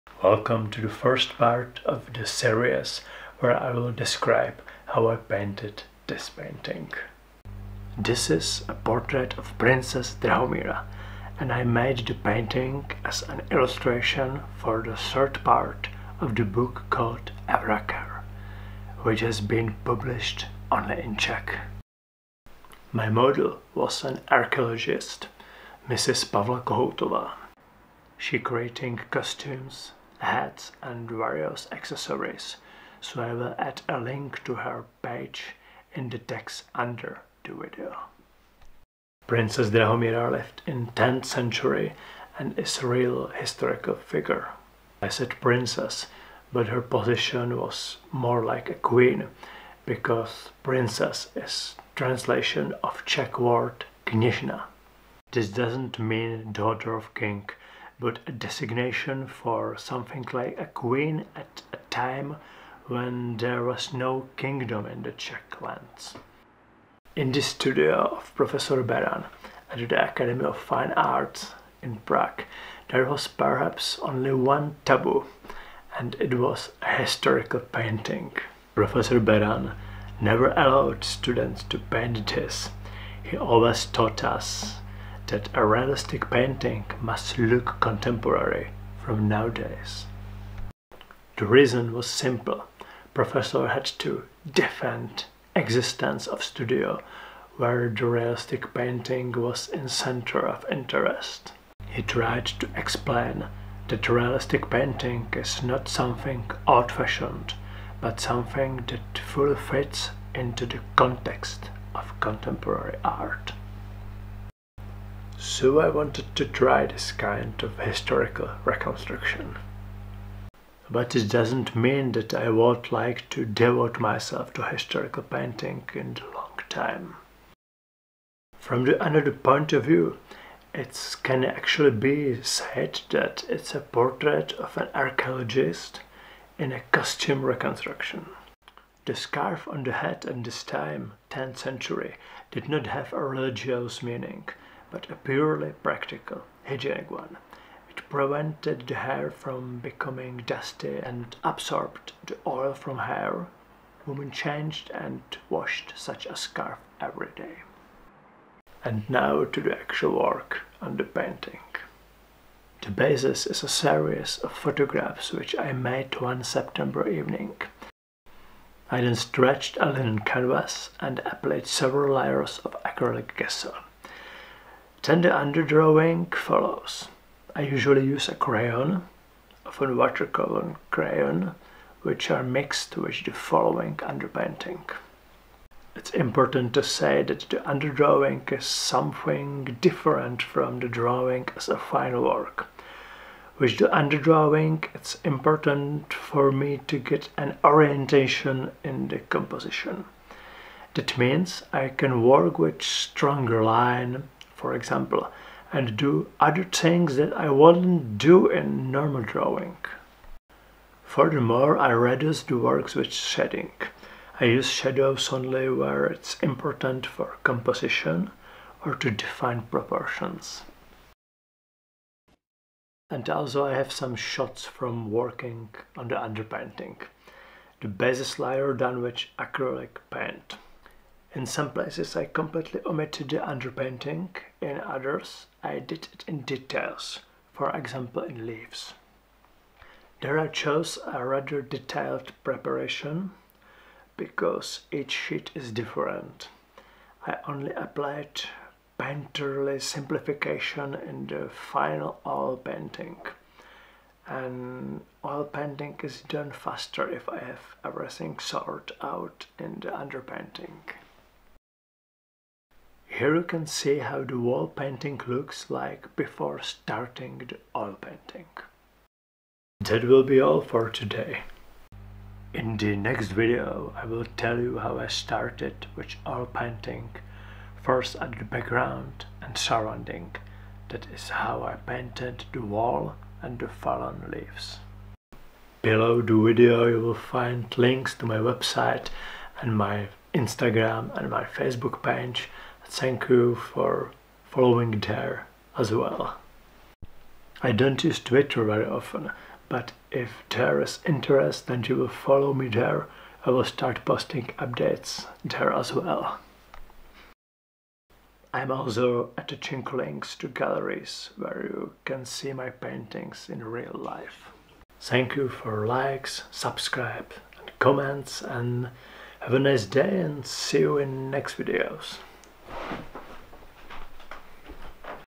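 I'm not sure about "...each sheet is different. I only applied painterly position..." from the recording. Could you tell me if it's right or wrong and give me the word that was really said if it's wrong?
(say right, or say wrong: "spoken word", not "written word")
wrong: "simplification", not "position".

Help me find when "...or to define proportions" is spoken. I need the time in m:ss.
3:38.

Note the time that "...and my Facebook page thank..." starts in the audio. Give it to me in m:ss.
4:51.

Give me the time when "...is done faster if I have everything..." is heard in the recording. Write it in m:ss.
4:16.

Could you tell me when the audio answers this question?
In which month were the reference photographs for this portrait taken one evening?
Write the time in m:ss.
2:46.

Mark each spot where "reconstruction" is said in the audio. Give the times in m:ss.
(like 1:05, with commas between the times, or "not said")
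1:58, 2:17.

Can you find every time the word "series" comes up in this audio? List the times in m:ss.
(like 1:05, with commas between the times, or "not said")
0:02, 2:43.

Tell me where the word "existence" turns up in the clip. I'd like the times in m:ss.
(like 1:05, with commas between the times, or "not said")
1:35.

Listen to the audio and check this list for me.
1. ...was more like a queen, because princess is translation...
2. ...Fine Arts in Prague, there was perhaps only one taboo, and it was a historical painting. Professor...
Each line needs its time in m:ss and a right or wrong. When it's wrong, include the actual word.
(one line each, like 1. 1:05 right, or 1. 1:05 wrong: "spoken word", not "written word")
1. 0:47 right
2. 1:10 right.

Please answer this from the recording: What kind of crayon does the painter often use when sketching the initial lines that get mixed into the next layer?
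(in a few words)
watercolor crayon.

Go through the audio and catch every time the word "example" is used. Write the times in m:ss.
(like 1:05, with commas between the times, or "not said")
3:24, 3:57.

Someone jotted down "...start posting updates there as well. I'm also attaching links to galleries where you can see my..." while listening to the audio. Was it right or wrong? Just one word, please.
right.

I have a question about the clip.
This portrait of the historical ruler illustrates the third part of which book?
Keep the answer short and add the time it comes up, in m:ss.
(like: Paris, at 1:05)
Avrakar, at 0:17.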